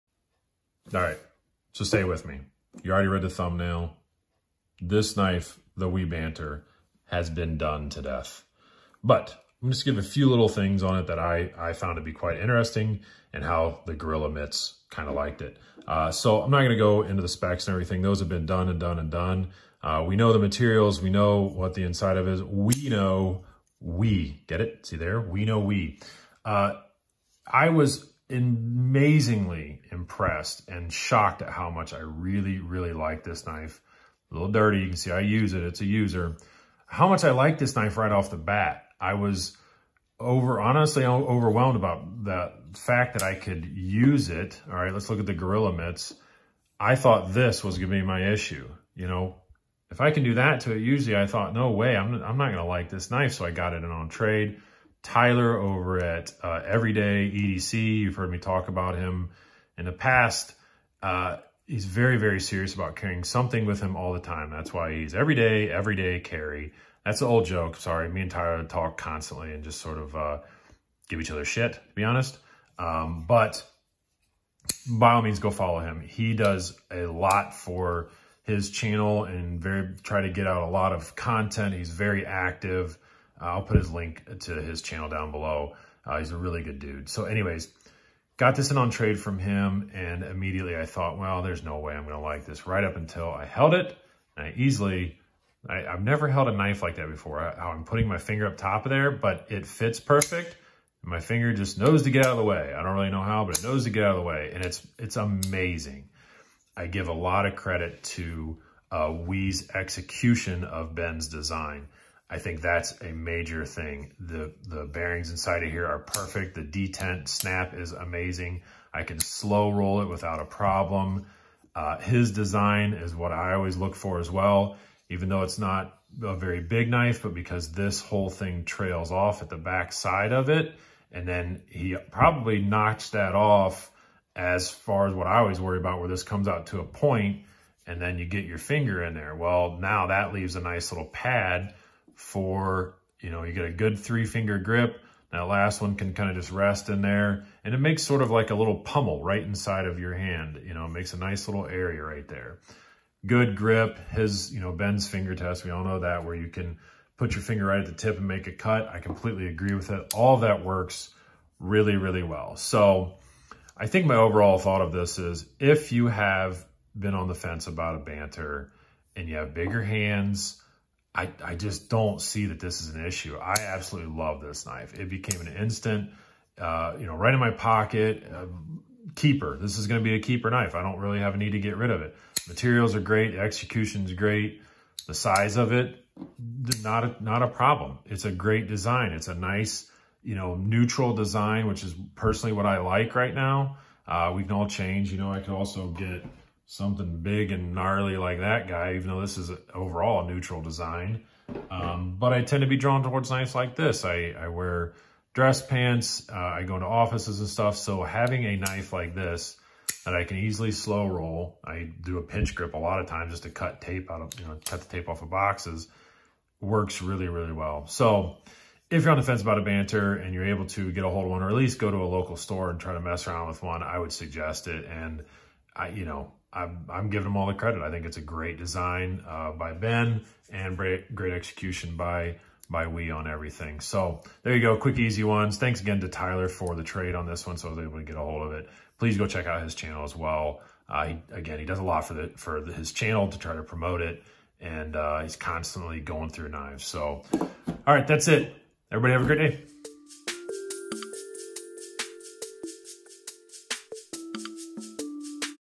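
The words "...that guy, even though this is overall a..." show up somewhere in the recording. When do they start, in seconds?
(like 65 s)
198 s.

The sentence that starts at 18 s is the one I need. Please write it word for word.
Those have been done and done and done.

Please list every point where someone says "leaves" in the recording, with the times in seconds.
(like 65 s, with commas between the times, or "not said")
140 s.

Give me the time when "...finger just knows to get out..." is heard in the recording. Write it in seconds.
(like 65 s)
101 s.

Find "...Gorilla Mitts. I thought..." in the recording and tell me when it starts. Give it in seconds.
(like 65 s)
45 s.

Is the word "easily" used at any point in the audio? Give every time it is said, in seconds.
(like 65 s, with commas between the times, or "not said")
94 s, 210 s.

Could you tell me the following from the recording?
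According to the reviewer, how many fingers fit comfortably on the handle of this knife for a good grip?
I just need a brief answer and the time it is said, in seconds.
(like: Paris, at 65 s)
3, at 143 s.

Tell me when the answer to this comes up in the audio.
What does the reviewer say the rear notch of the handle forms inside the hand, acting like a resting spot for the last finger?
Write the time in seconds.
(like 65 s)
148 s.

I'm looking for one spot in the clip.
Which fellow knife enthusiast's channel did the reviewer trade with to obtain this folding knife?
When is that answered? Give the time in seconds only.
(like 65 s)
56 s.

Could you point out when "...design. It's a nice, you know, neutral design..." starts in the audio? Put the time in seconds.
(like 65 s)
188 s.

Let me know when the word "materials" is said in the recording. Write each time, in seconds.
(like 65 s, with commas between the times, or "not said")
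20 s, 182 s.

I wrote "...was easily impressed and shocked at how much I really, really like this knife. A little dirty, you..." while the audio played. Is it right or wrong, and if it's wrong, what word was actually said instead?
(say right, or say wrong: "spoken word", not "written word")
wrong: "amazingly", not "easily".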